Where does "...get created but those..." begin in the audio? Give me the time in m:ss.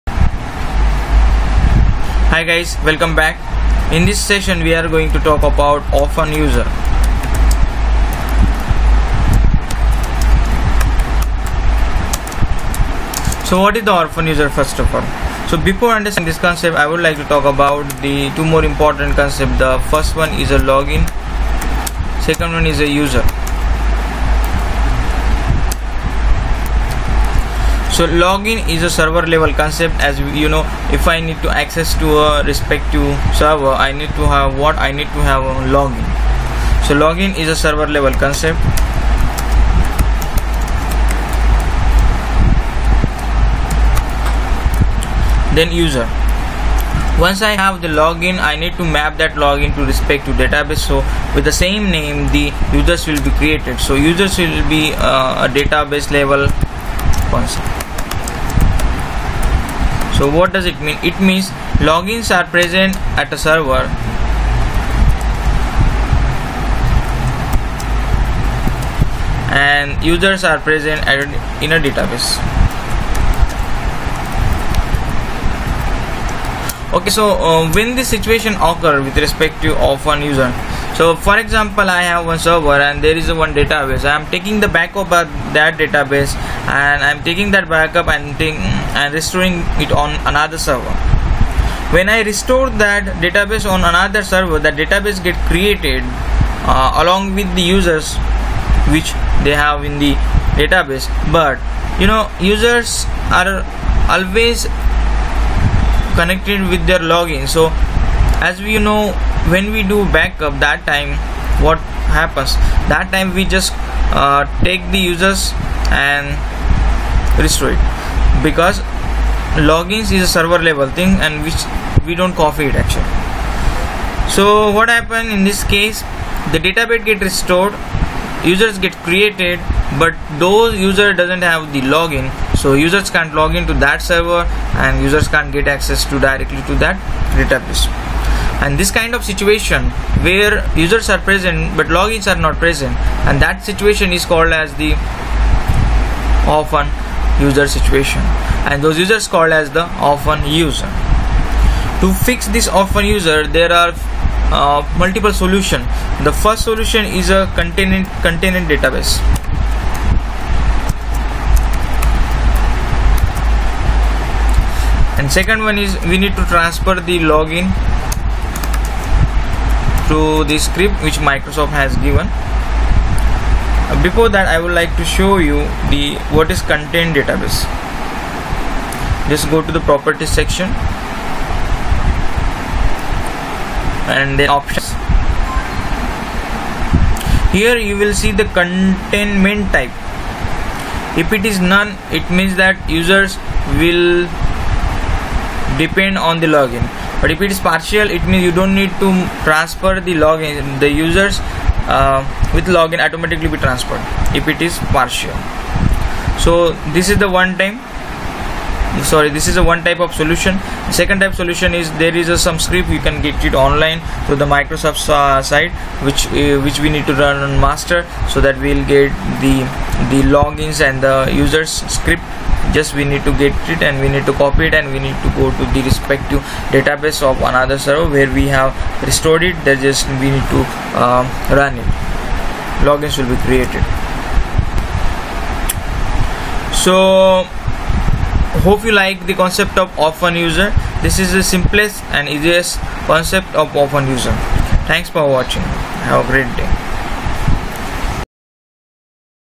2:08.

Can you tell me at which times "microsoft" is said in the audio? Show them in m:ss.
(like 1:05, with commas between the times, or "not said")
2:51, 3:34.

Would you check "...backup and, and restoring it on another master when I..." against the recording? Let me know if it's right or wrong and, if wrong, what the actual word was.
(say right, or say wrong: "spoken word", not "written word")
wrong: "server", not "master".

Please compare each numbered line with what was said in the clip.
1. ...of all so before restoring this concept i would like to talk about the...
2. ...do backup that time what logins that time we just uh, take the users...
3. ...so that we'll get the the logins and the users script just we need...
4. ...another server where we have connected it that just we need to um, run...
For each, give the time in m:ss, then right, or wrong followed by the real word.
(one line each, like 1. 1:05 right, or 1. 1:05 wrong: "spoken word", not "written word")
1. 0:14 wrong: "understanding", not "restoring"
2. 1:49 wrong: "happens", not "logins"
3. 3:38 right
4. 3:47 wrong: "restored", not "connected".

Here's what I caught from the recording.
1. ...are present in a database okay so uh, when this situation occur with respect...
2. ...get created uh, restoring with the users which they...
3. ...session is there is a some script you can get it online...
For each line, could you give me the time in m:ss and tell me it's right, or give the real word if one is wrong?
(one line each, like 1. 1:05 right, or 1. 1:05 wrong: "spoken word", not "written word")
1. 1:10 right
2. 1:35 wrong: "along", not "restoring"
3. 3:31 wrong: "solution", not "session".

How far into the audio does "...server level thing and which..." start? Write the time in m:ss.
2:00.